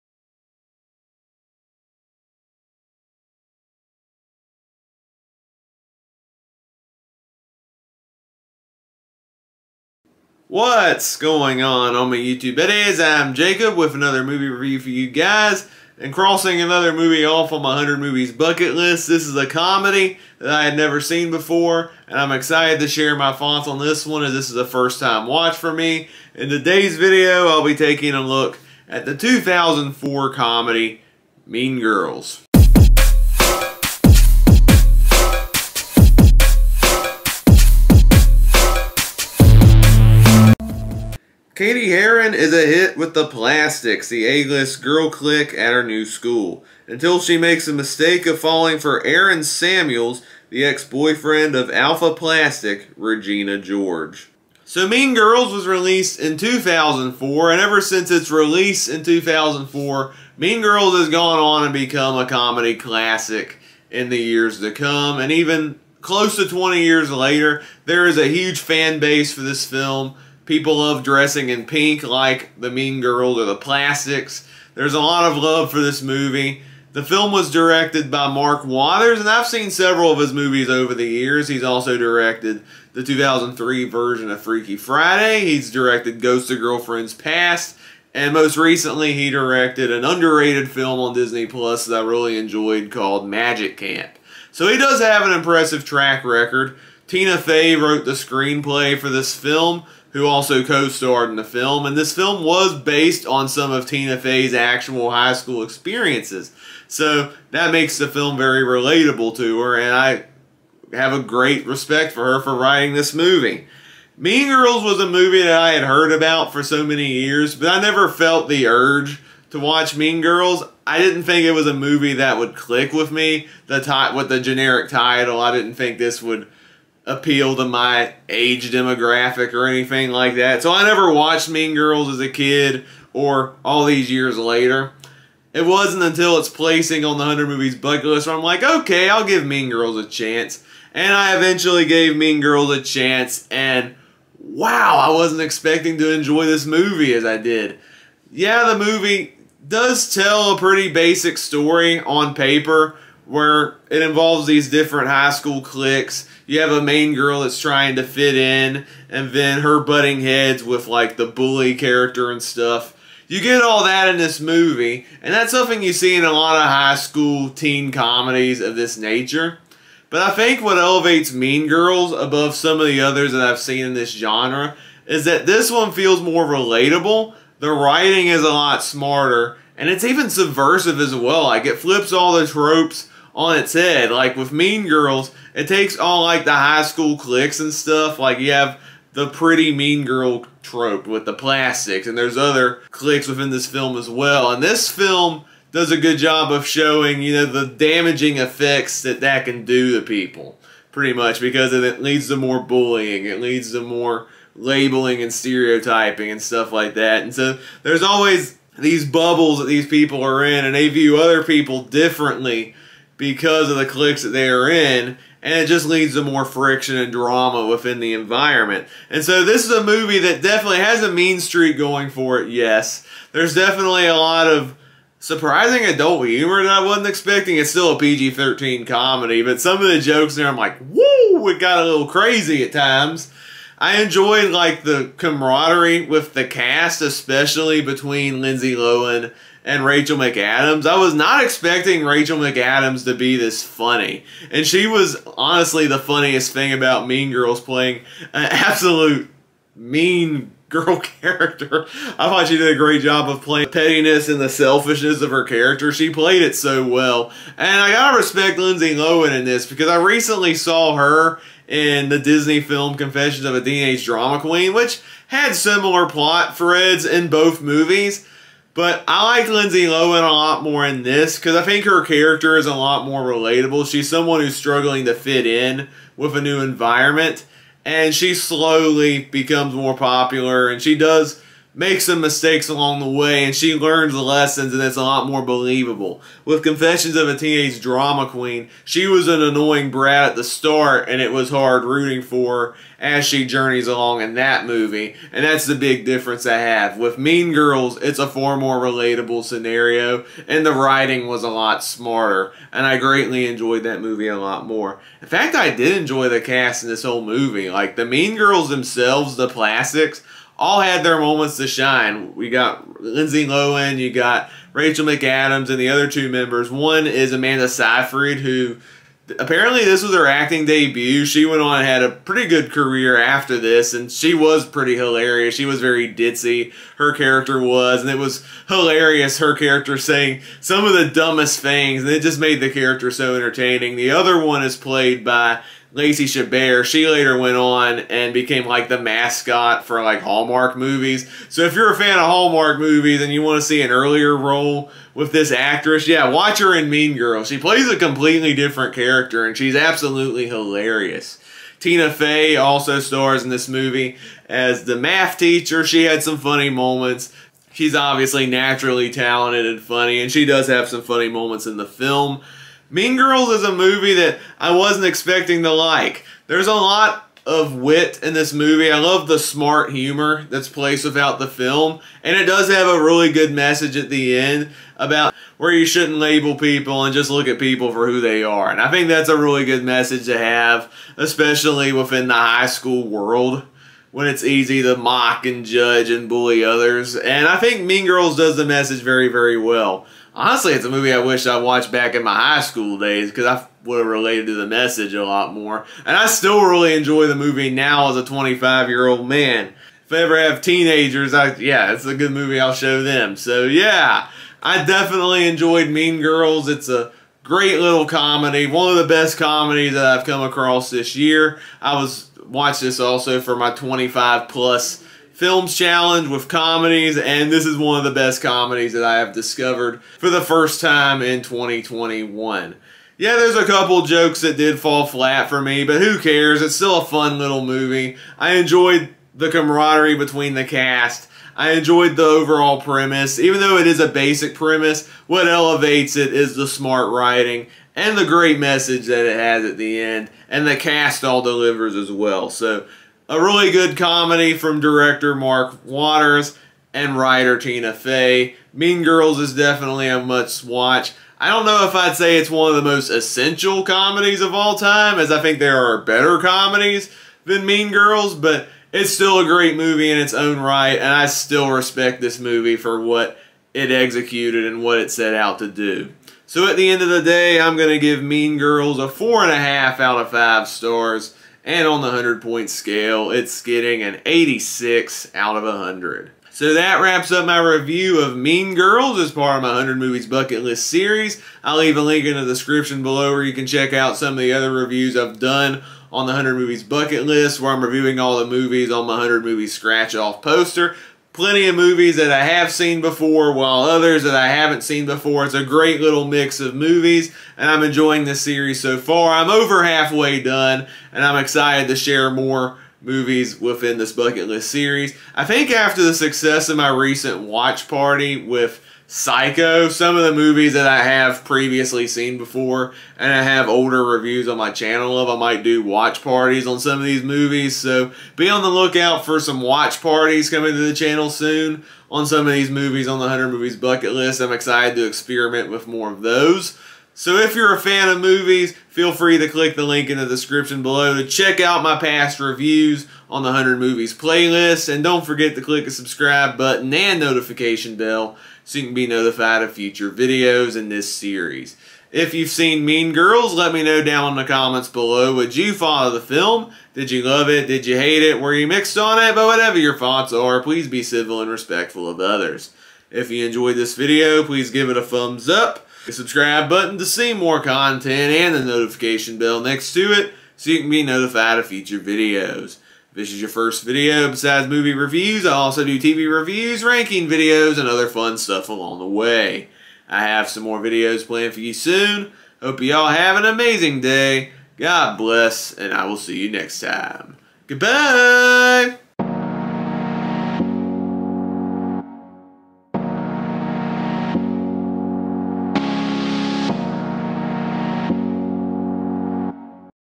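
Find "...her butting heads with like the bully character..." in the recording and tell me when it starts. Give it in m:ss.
2:39.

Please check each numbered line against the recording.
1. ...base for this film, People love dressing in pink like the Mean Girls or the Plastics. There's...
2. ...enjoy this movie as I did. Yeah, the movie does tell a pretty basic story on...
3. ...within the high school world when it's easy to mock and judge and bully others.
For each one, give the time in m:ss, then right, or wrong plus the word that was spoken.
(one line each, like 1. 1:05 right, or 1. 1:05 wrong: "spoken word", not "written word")
1. 1:08 right
2. 2:26 right
3. 6:21 right.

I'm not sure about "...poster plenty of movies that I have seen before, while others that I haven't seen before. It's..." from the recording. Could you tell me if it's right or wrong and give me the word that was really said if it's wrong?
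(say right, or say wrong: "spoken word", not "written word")
right.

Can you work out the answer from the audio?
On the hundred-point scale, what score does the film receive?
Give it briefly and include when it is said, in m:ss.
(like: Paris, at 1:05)
86, at 7:54.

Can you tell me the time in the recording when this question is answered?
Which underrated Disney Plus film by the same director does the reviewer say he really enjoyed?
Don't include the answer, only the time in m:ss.
1:33.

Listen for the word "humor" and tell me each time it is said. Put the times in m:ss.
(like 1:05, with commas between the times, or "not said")
3:46, 6:09.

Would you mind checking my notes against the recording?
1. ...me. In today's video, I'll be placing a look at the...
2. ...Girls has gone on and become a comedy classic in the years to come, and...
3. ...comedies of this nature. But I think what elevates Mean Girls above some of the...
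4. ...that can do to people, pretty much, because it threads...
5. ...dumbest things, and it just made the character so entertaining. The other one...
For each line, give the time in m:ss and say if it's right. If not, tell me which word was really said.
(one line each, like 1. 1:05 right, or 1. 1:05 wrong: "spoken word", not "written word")
1. 0:25 wrong: "taking", not "placing"
2. 1:00 right
3. 2:47 right
4. 3:19 wrong: "leads", not "threads"
5. 5:31 right.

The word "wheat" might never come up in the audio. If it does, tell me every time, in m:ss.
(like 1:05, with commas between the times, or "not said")
not said.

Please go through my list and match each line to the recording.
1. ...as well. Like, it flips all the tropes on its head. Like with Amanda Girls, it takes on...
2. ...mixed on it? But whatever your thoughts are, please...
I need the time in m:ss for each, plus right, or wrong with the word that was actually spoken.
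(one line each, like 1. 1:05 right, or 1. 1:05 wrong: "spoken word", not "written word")
1. 3:00 wrong: "Mean", not "Amanda"
2. 9:08 right.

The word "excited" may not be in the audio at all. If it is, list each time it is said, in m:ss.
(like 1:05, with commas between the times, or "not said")
0:22, 8:21, 8:44.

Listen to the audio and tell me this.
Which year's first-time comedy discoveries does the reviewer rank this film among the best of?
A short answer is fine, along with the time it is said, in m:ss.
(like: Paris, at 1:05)
2021, at 7:01.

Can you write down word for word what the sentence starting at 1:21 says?
He's also directed the 2003 version of Freaky Friday.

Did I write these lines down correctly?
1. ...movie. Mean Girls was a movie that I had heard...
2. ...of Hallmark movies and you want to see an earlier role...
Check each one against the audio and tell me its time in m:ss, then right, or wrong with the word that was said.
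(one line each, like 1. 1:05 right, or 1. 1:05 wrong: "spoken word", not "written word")
1. 1:53 right
2. 5:42 right.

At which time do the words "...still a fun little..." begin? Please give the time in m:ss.
7:06.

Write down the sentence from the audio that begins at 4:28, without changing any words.
But I like Lindsay Lohan a lot more in this because I think her character is a lot more relatable.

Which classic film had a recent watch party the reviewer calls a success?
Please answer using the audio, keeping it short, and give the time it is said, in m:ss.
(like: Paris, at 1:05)
Psycho, at 8:29.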